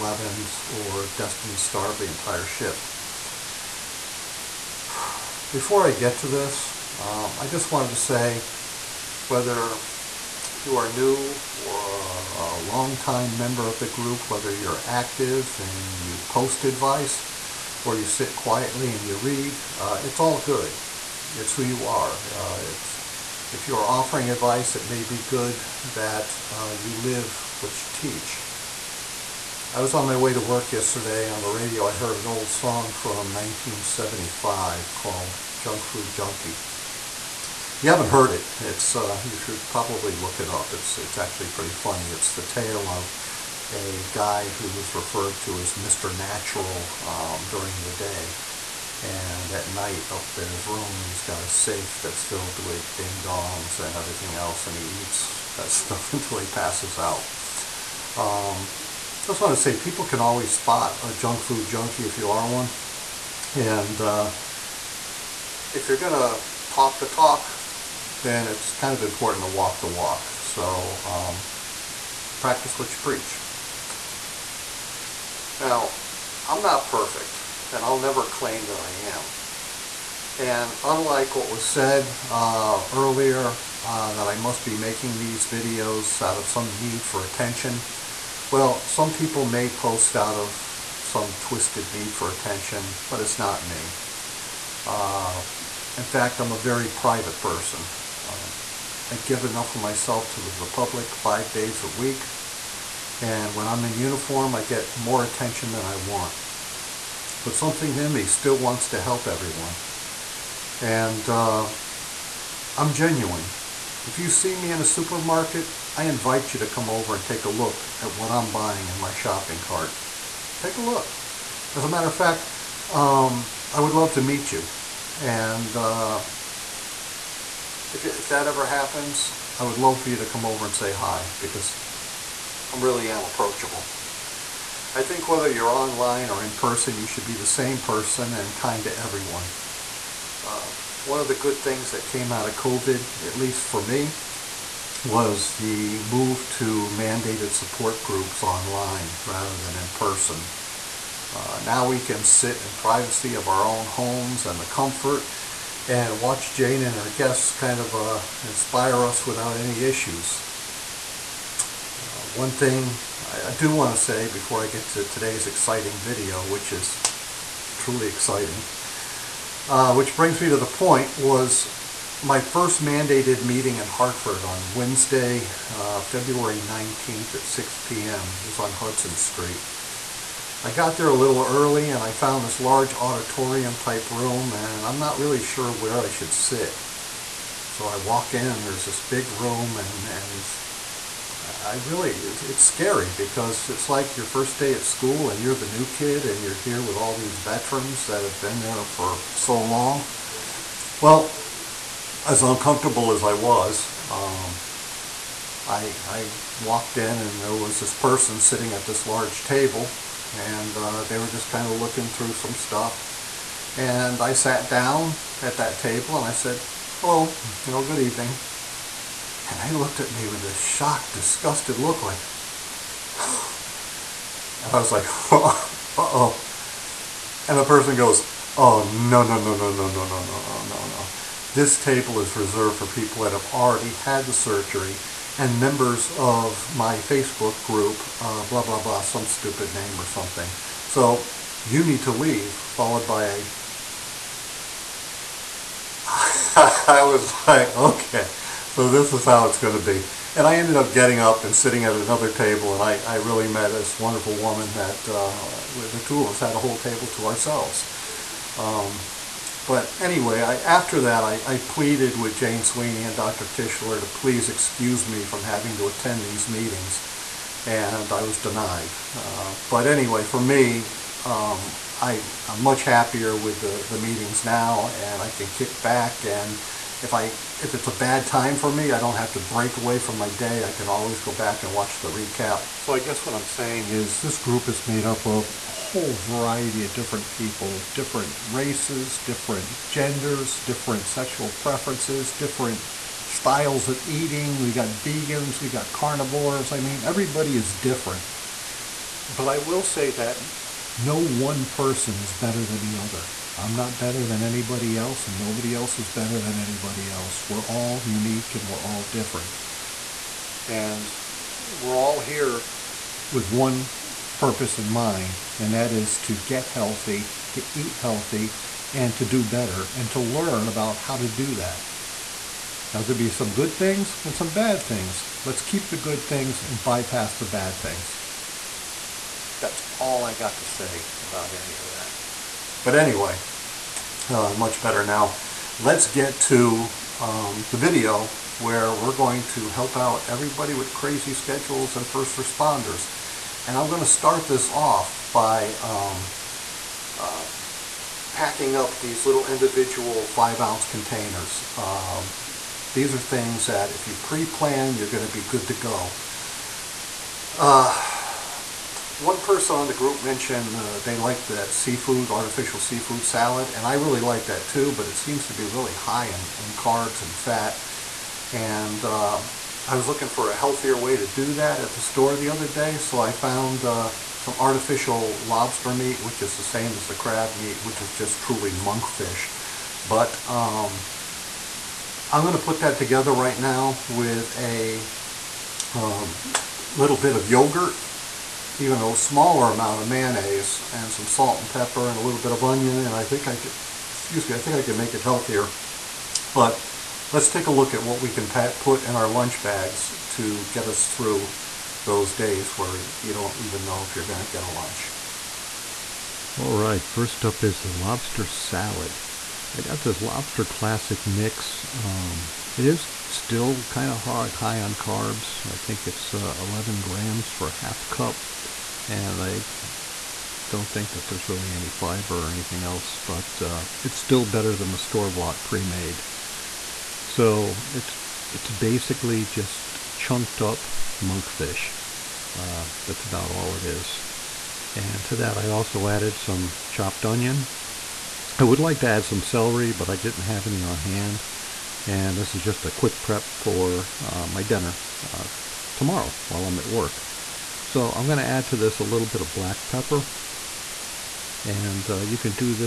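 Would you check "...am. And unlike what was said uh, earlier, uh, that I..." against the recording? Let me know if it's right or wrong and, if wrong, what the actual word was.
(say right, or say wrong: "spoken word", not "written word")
right.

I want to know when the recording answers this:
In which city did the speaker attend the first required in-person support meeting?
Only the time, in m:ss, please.
2:53.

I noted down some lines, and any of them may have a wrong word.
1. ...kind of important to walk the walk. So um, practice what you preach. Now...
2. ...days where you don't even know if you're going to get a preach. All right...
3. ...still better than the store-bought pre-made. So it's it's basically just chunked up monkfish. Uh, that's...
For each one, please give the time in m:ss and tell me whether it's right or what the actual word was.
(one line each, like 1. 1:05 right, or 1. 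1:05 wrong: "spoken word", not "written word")
1. 1:08 right
2. 6:42 wrong: "lunch", not "preach"
3. 7:04 right.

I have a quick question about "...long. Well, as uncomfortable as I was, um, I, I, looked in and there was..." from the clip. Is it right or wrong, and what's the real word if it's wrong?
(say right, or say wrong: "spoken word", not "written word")
wrong: "walked", not "looked".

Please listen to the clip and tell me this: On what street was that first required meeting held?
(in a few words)
Hudson Street.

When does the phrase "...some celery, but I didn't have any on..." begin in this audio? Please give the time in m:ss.
7:19.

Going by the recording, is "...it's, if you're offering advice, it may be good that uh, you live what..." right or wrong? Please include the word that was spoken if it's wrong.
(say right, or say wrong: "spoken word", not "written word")
right.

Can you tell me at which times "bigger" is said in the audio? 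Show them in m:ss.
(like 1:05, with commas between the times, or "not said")
not said.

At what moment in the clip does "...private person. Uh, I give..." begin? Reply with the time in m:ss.
1:36.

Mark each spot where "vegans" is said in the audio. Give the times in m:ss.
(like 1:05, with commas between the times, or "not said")
4:55.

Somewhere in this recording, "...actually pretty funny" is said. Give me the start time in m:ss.
0:41.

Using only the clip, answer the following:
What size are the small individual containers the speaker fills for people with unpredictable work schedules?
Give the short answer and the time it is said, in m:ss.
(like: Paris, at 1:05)
5-ounce, at 5:50.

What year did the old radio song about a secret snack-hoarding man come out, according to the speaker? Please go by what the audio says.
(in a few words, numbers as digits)
1975.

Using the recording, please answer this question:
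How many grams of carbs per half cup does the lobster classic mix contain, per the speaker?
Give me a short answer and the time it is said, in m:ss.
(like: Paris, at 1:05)
11 grams, at 6:56.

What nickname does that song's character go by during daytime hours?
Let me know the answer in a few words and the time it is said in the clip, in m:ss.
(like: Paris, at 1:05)
Mr. Natural, at 0:45.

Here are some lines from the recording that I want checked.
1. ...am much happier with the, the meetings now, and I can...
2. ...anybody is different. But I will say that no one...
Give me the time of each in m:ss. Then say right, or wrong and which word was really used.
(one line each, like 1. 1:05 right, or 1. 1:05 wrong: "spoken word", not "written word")
1. 4:32 right
2. 4:57 wrong: "everybody", not "anybody".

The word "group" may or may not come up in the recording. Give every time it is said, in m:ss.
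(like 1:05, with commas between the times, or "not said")
0:13, 2:28, 3:57, 4:44, 5:59.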